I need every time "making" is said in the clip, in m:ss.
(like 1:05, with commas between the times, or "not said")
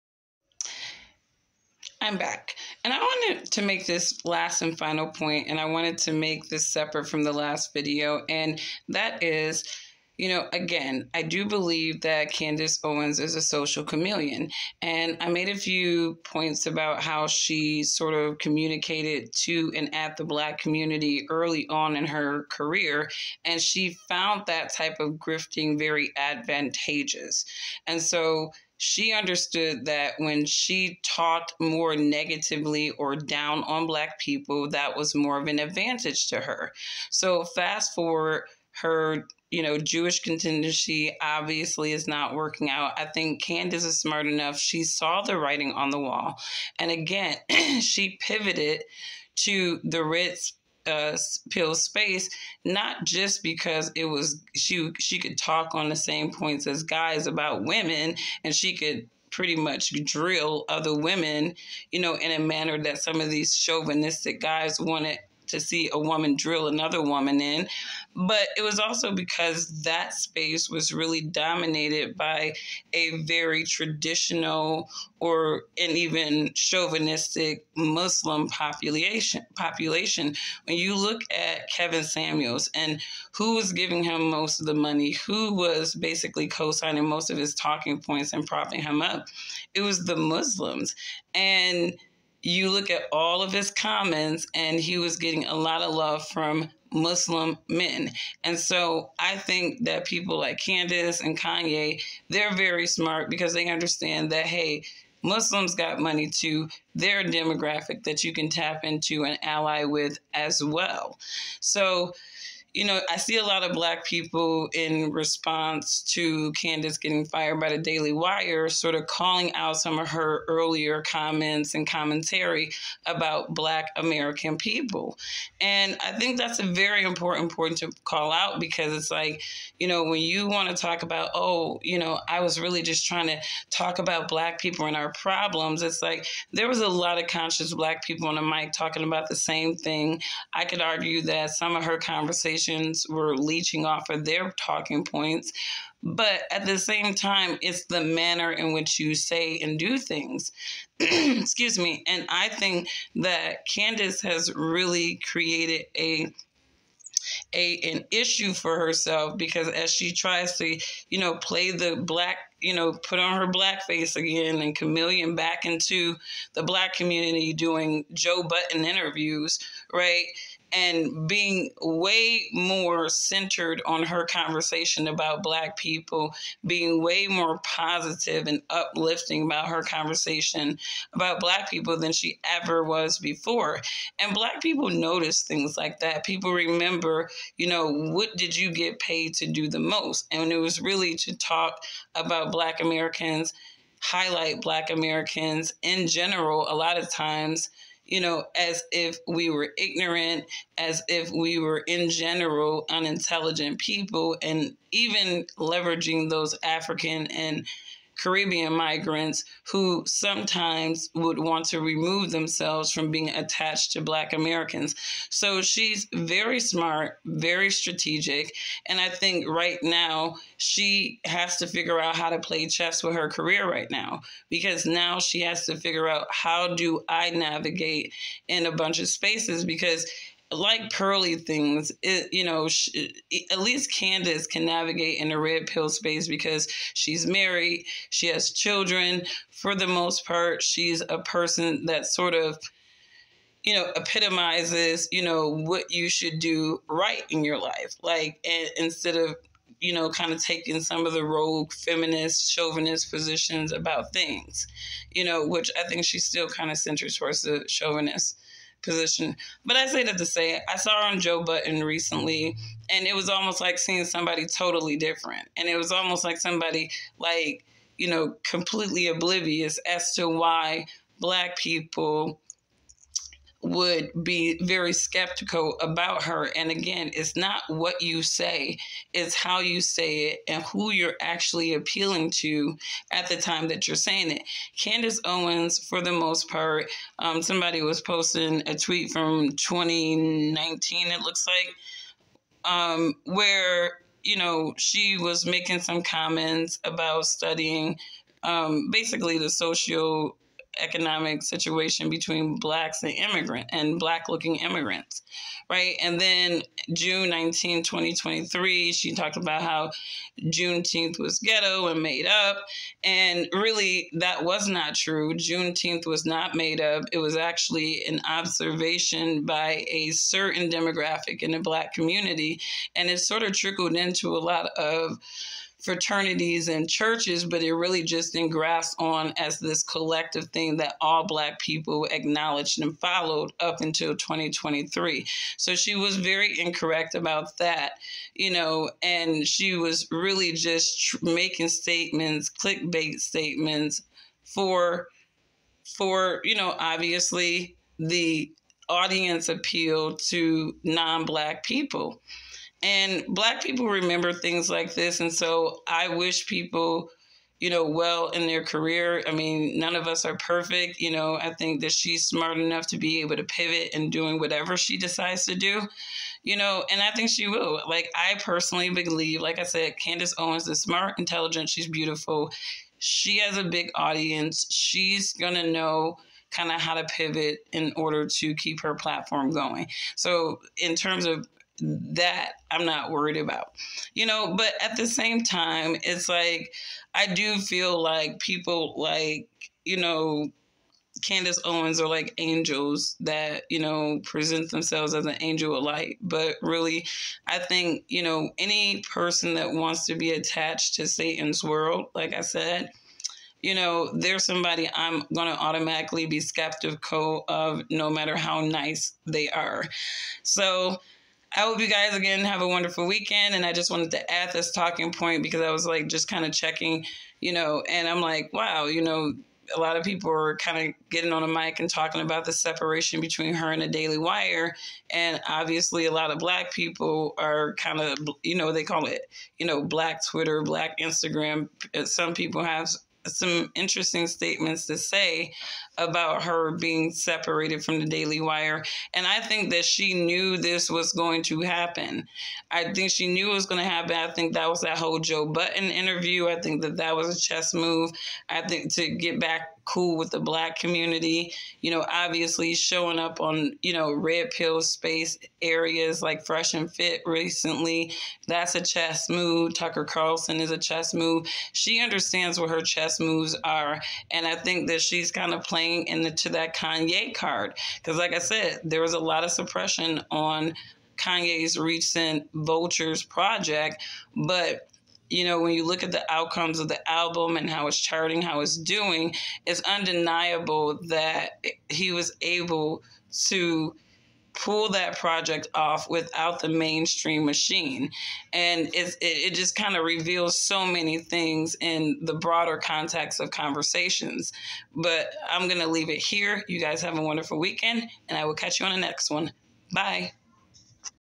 4:55, 5:41.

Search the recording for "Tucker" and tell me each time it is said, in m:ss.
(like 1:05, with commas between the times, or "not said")
7:39.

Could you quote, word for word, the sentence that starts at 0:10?
You know, again, I do believe that Candace Owens is a social chameleon.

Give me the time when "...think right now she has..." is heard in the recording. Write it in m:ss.
3:39.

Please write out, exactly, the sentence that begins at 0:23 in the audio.
And she found that type of grifting very advantageous.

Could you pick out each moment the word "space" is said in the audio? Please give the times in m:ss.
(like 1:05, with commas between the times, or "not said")
0:51, 1:10, 3:49, 3:55, 7:34.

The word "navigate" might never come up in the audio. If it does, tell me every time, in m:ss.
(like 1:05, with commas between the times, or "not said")
3:47, 3:54.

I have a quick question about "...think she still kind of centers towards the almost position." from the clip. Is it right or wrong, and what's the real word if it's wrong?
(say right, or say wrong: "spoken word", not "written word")
wrong: "chauvinist", not "almost".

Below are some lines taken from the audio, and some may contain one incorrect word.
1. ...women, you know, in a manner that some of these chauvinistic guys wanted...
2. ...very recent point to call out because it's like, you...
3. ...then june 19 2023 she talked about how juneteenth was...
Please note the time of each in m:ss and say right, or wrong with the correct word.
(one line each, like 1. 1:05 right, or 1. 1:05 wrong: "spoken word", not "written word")
1. 1:00 right
2. 2:06 wrong: "important", not "recent"
3. 5:06 right.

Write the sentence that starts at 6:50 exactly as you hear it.
So, I hope you guys again have a wonderful weekend.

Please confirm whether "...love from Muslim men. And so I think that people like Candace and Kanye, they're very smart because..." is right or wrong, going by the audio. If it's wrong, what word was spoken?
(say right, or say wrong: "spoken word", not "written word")
right.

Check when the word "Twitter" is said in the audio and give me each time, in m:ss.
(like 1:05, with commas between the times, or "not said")
7:10.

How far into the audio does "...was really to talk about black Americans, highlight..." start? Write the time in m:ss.
3:10.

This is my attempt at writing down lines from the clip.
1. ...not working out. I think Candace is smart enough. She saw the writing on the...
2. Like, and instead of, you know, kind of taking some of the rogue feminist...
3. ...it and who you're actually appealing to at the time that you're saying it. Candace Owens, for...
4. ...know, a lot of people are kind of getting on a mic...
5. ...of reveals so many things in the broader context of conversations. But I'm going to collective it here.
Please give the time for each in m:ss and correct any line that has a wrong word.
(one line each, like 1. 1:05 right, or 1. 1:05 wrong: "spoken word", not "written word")
1. 0:42 right
2. 4:08 right
3. 4:40 right
4. 6:59 right
5. 8:09 wrong: "leave", not "collective".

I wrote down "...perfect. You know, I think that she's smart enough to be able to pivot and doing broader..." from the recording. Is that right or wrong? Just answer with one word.
wrong.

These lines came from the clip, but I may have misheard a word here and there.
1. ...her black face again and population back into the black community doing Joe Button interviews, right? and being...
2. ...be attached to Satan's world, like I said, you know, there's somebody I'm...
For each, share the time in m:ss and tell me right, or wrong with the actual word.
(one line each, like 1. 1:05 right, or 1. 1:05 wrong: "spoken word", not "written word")
1. 2:43 wrong: "chameleon", not "population"
2. 6:40 right.